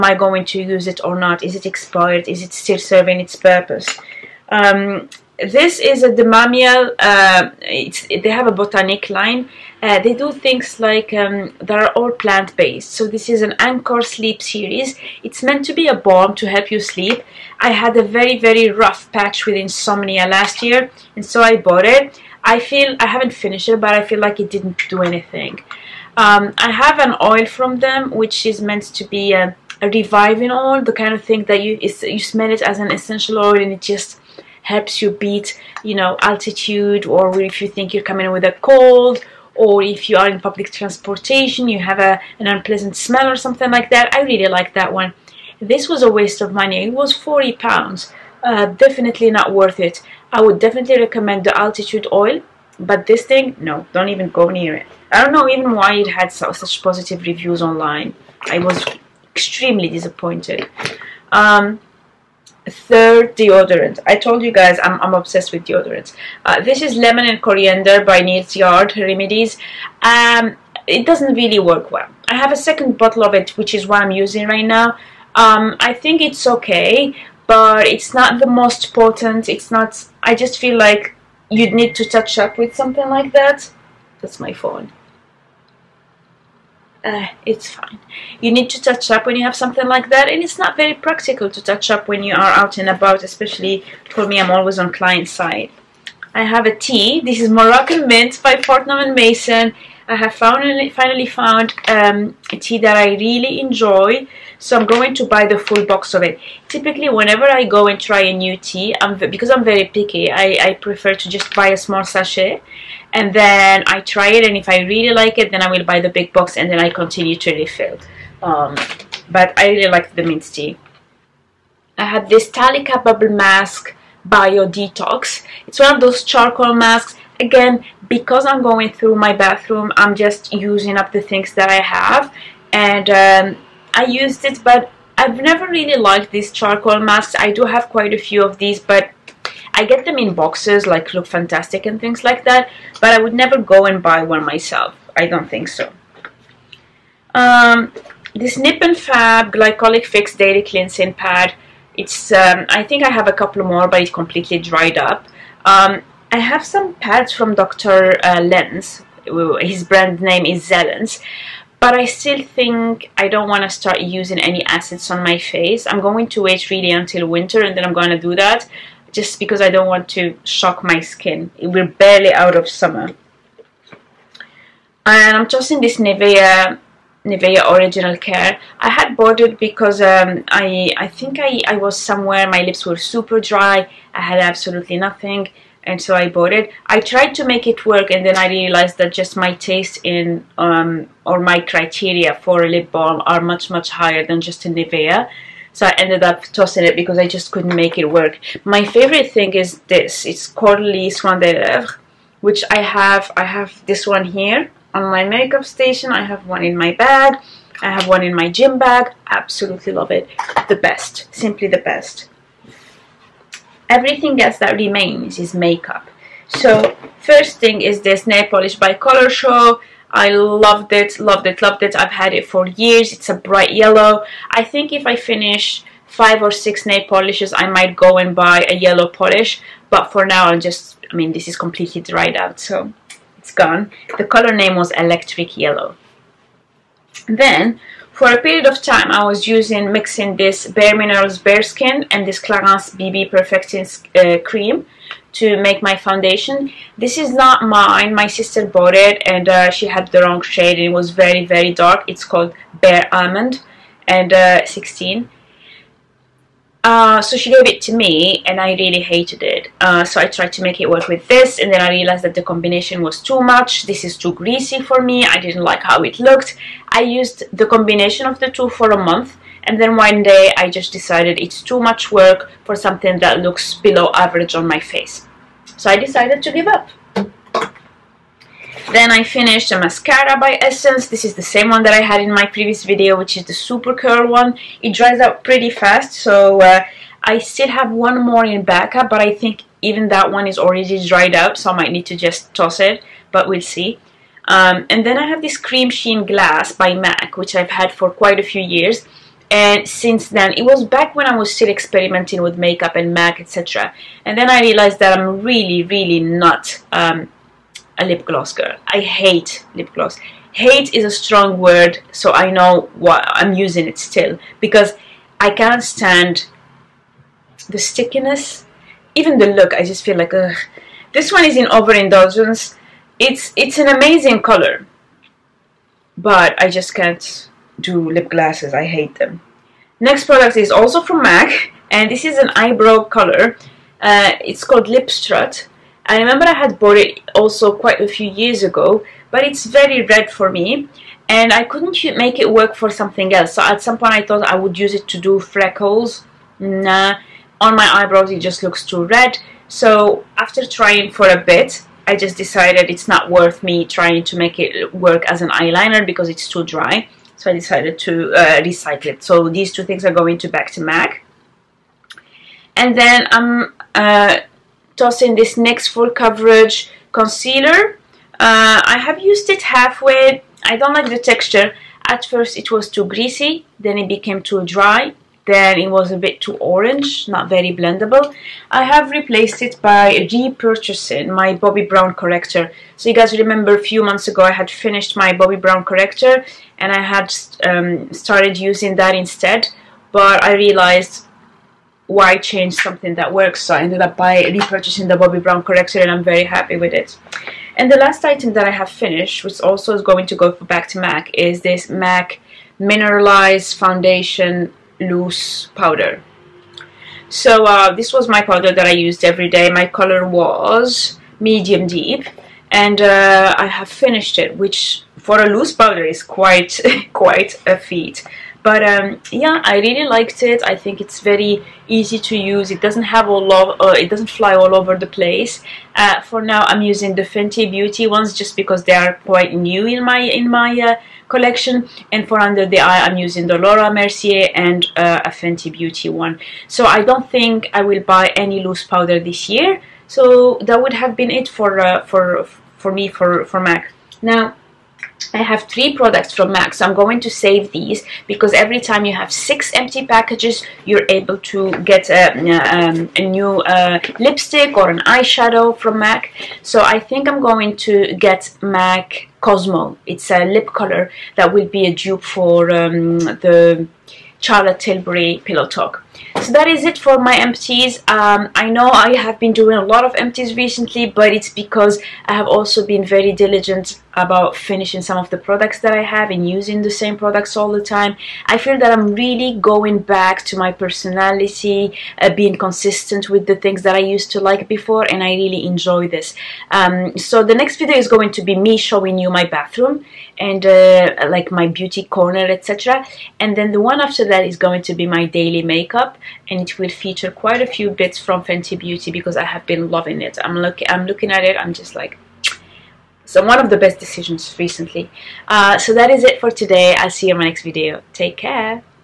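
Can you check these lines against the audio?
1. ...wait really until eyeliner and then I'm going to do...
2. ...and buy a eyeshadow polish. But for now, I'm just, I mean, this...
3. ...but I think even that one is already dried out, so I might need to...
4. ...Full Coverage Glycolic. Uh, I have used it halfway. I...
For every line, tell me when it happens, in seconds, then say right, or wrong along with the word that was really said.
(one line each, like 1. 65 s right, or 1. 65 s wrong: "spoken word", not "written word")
1. 166 s wrong: "winter", not "eyeliner"
2. 228 s wrong: "yellow", not "eyeshadow"
3. 289 s right
4. 365 s wrong: "Concealer", not "Glycolic".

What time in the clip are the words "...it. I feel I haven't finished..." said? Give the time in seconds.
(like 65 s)
21 s.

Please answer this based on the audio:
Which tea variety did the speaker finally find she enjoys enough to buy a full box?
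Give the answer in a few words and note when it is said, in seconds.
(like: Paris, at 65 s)
Moroccan Mint, at 97 s.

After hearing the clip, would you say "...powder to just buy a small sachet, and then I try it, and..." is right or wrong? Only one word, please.
wrong.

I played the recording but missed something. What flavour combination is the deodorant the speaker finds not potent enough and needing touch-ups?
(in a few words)
lemon and coriander.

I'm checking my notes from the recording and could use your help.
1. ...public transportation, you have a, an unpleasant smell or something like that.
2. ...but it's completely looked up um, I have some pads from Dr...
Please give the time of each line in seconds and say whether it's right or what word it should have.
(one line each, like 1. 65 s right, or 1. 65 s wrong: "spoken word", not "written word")
1. 40 s right
2. 153 s wrong: "dried", not "looked".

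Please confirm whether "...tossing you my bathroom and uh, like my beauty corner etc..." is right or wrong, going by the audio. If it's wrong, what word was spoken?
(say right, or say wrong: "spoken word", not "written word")
wrong: "showing", not "tossing".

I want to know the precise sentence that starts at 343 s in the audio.
So at some point I thought I would use it to do freckles.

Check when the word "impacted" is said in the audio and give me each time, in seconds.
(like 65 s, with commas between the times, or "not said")
not said.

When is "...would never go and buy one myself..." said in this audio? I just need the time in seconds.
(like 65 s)
143 s.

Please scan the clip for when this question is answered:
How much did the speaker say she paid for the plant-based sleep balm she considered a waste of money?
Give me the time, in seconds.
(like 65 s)
47 s.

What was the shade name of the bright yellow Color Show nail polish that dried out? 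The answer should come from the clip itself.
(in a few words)
Electric Yellow.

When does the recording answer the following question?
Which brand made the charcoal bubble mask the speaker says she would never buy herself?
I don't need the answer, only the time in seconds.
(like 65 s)
122 s.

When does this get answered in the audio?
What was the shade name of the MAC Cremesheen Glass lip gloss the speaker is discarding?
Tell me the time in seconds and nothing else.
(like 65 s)
321 s.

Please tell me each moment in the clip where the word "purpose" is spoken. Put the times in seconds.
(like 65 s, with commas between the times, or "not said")
3 s.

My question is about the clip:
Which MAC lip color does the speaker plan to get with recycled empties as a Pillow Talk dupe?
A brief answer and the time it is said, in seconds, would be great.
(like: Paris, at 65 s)
Cosmo, at 459 s.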